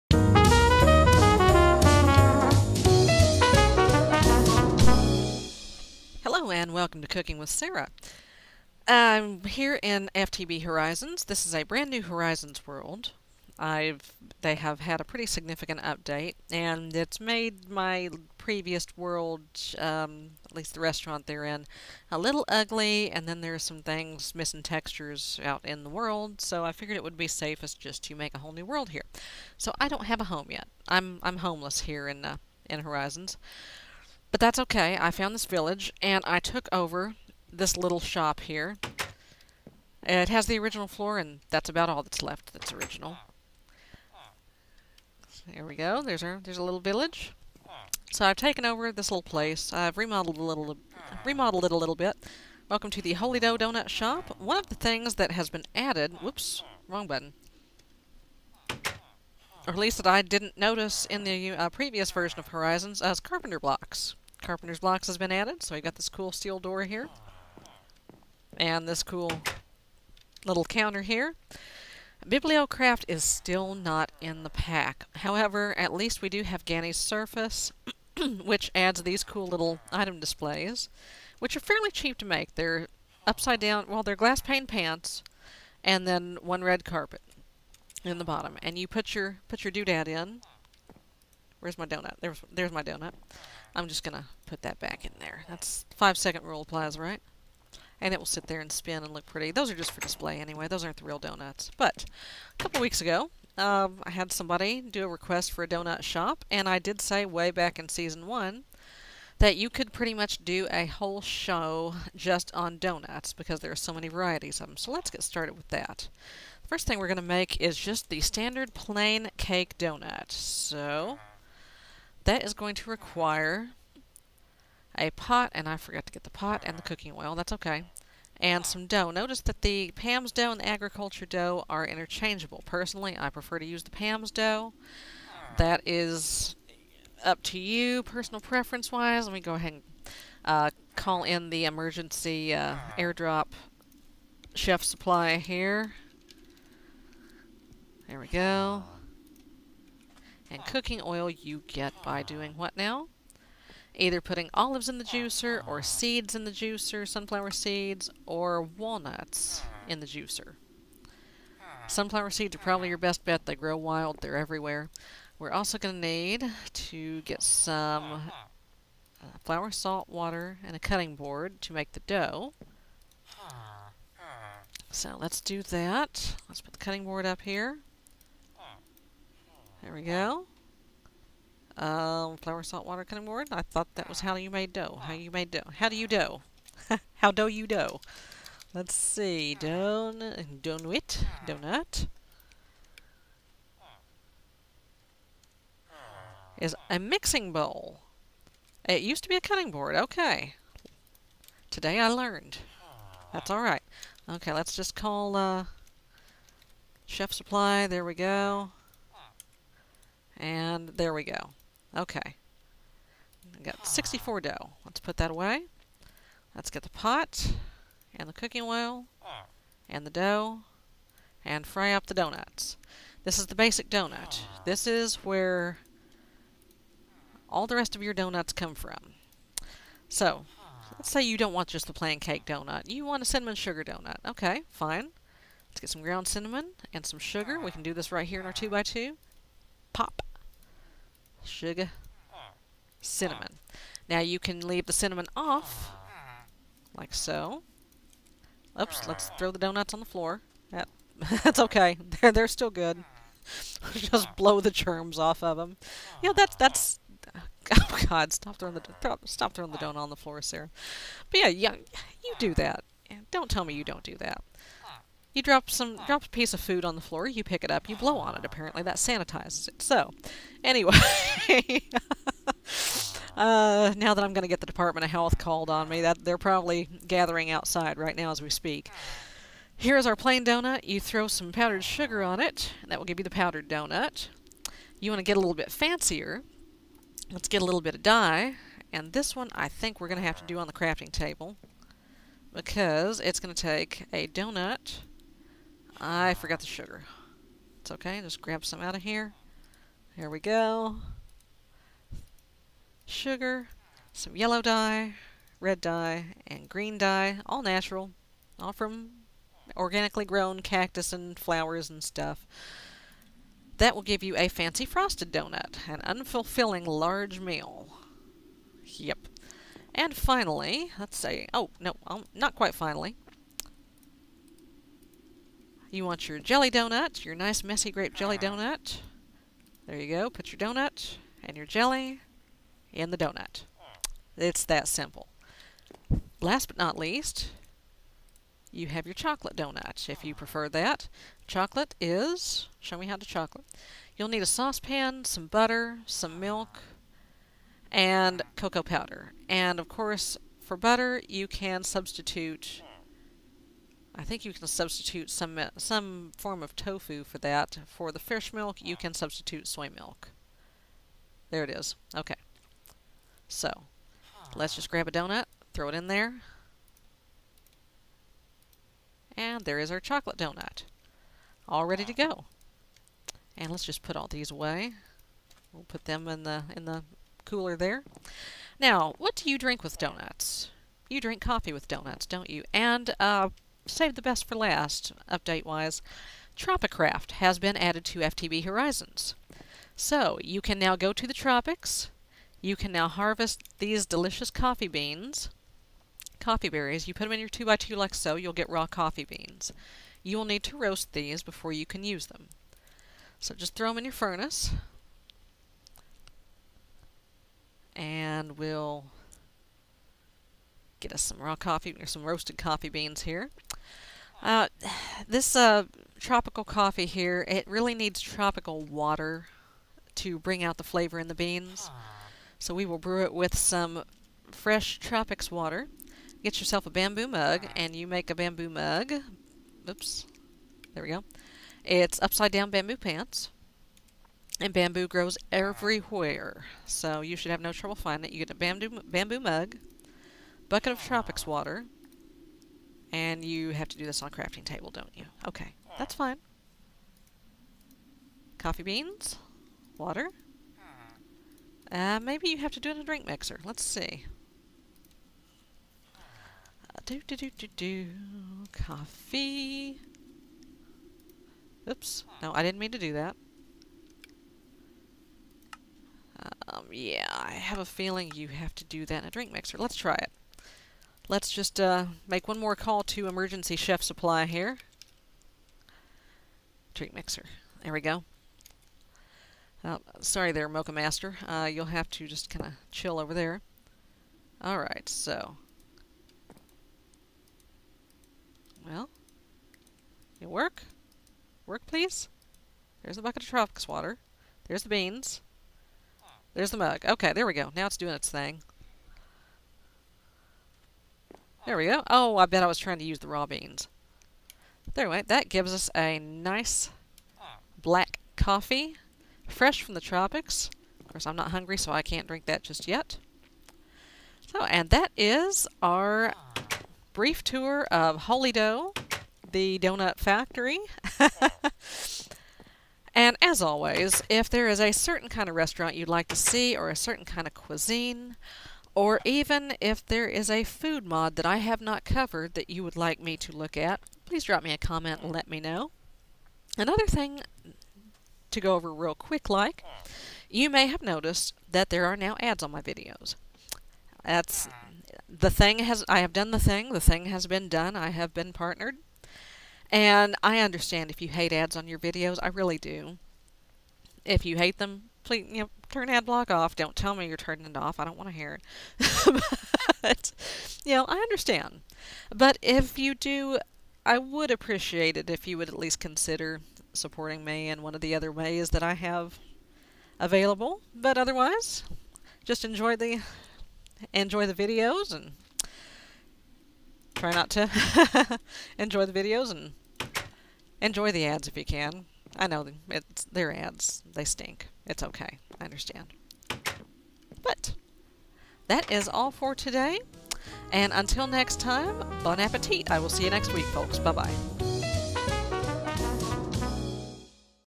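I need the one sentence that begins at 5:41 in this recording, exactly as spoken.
Chocolate is, show me how to chocolate.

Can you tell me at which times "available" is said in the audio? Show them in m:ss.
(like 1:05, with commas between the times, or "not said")
9:30.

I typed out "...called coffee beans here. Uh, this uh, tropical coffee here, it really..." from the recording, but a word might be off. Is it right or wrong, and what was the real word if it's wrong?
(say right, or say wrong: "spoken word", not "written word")
wrong: "roasted", not "called".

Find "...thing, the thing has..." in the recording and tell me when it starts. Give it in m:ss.
9:06.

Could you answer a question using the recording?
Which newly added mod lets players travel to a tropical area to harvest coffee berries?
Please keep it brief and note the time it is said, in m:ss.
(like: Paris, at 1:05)
Tropicraft, at 6:26.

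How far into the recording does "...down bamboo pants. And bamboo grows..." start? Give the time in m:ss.
7:12.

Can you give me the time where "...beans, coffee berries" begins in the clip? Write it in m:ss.
6:34.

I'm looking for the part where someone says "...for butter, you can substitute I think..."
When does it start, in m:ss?
5:50.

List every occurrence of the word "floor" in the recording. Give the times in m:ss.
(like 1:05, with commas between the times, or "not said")
0:40, 4:10, 4:20, 4:27.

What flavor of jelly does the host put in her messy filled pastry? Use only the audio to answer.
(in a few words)
Grape.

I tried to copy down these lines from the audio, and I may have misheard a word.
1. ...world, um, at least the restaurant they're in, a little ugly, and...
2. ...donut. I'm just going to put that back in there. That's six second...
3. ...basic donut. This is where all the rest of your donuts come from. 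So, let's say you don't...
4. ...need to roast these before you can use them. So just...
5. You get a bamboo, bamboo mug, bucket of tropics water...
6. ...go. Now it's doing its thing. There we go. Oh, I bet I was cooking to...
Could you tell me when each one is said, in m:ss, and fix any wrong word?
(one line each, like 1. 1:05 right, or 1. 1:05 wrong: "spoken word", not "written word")
1. 0:18 right
2. 1:32 wrong: "five", not "six"
3. 3:43 right
4. 6:40 right
5. 7:18 right
6. 8:17 wrong: "trying", not "cooking".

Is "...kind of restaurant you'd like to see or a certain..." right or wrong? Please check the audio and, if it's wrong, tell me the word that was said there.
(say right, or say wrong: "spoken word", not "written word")
right.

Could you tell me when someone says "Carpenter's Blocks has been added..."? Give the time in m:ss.
1:04.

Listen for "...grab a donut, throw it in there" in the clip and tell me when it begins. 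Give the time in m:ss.
6:04.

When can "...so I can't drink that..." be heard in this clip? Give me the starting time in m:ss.
8:31.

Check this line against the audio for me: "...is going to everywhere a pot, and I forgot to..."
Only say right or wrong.
wrong.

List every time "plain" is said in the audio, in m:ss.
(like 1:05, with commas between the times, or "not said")
1:58, 3:51, 4:40.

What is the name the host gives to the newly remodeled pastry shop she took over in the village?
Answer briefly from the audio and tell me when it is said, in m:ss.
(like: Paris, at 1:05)
Holy Dough Donut Shop, at 0:53.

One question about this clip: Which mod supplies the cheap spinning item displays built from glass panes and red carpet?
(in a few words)
Ganny's Surface.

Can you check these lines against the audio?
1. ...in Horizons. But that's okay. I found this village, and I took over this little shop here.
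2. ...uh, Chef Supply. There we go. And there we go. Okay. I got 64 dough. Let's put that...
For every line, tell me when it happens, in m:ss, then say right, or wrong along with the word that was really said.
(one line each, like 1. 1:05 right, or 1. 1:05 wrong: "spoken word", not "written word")
1. 0:32 right
2. 3:25 right.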